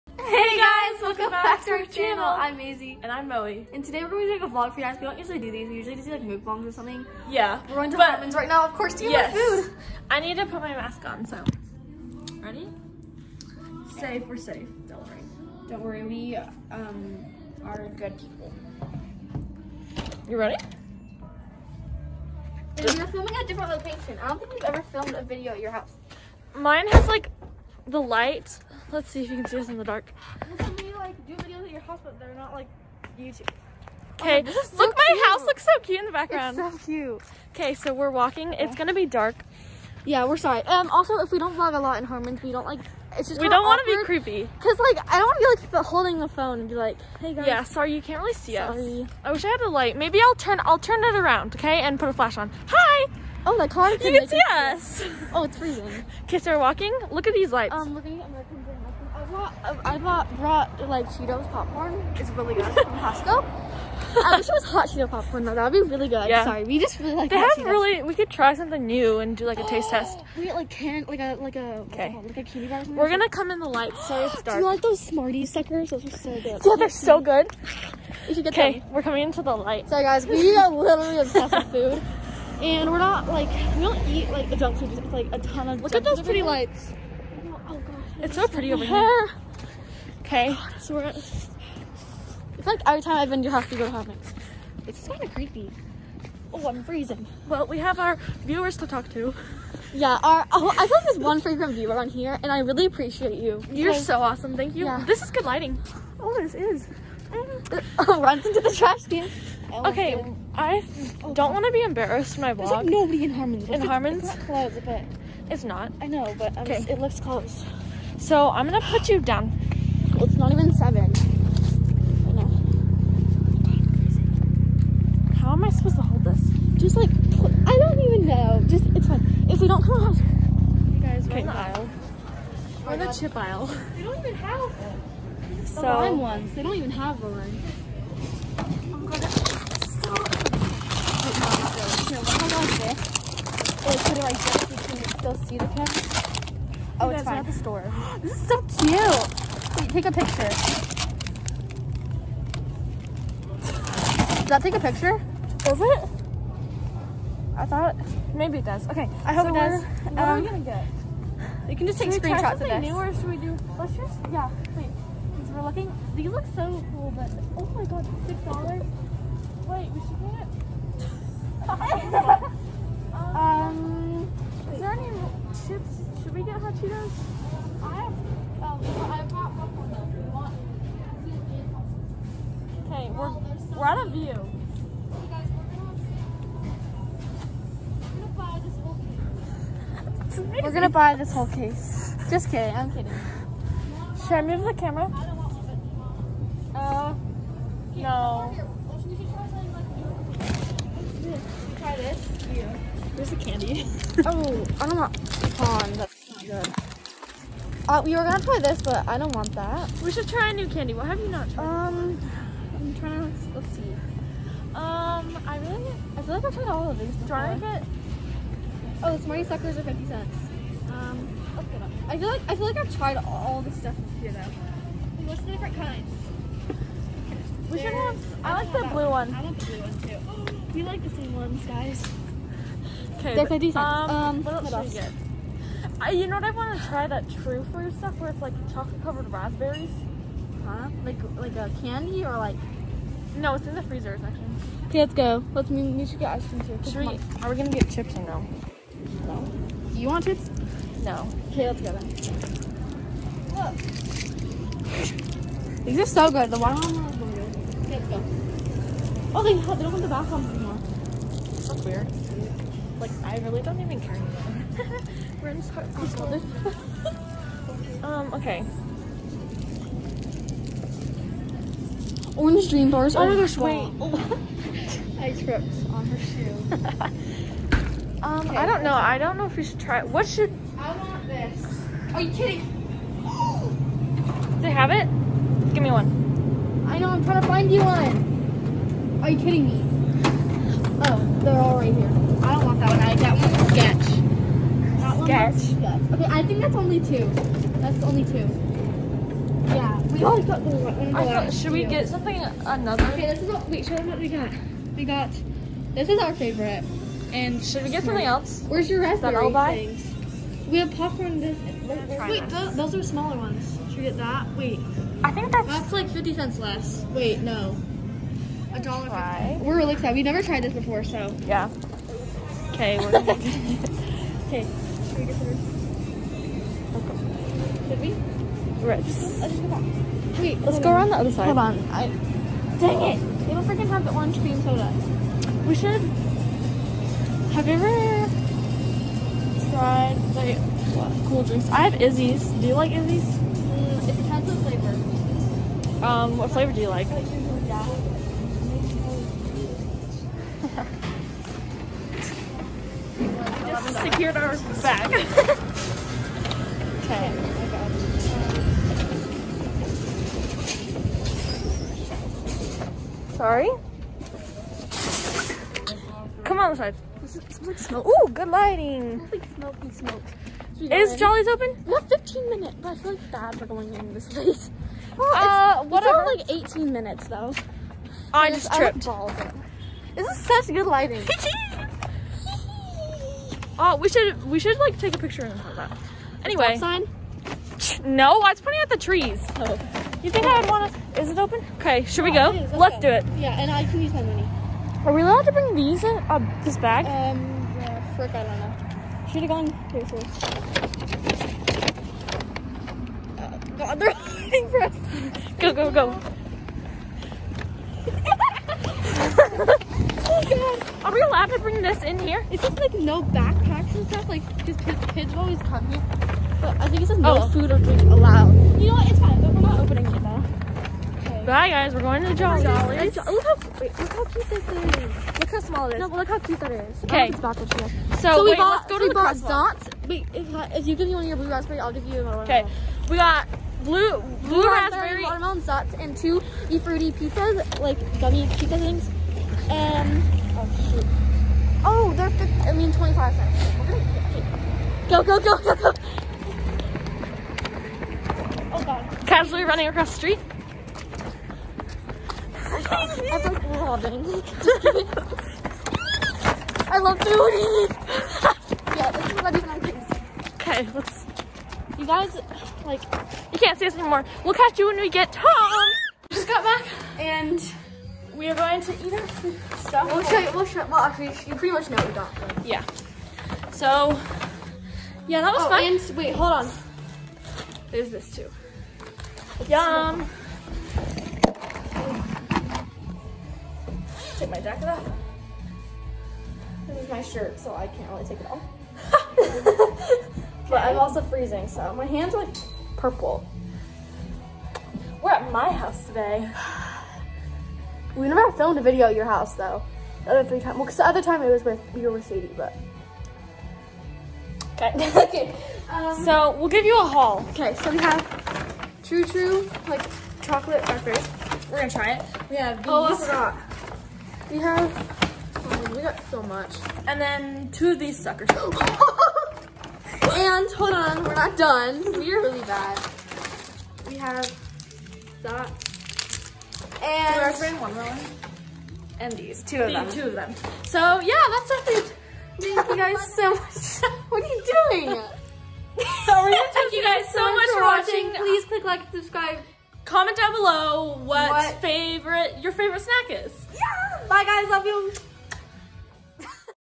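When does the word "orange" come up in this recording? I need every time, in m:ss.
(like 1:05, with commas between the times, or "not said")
2:17, 4:32, 5:34.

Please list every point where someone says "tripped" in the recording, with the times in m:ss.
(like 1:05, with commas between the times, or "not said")
4:35, 6:18.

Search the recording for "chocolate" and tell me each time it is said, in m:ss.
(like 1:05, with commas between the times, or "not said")
3:58, 8:30.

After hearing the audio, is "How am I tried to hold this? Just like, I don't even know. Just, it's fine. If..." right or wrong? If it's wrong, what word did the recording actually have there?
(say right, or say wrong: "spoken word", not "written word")
wrong: "supposed", not "tried".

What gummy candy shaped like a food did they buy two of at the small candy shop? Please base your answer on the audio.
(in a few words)
Fruity pizzas.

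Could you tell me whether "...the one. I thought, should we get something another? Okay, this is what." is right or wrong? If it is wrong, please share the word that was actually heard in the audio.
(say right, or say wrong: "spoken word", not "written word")
right.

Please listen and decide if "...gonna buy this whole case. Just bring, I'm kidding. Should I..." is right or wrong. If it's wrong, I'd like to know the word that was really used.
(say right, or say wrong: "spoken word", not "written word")
wrong: "kidding", not "bring".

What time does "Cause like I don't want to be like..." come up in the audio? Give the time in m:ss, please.
0:44.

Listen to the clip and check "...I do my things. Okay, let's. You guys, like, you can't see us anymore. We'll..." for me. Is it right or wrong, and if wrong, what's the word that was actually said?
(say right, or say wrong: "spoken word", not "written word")
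right.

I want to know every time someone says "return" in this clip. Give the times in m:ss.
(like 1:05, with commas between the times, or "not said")
not said.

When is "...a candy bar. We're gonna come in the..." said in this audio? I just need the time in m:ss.
1:12.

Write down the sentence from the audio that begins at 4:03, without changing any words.
No, it's in the freezer section.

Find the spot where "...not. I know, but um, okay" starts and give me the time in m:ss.
1:55.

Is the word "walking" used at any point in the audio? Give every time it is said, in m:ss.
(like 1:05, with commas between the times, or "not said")
0:38, 0:56.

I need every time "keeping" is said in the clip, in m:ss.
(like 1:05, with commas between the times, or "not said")
not said.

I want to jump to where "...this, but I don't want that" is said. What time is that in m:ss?
3:28.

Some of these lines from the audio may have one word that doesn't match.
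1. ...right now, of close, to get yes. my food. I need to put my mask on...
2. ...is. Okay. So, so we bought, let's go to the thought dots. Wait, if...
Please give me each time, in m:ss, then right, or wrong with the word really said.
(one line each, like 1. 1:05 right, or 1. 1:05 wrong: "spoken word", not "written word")
1. 0:08 wrong: "course", not "close"
2. 7:06 wrong: "bought", not "thought".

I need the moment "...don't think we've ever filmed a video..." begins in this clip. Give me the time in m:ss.
0:24.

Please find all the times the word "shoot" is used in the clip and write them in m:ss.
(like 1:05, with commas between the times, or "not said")
7:20.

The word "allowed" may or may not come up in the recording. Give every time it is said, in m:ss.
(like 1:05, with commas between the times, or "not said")
6:35, 6:51, 6:58.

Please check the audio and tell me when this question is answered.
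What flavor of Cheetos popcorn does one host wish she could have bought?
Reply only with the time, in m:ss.
1:04.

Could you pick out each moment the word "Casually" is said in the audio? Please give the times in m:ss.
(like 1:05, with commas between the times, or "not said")
7:29.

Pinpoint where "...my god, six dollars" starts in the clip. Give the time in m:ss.
2:47.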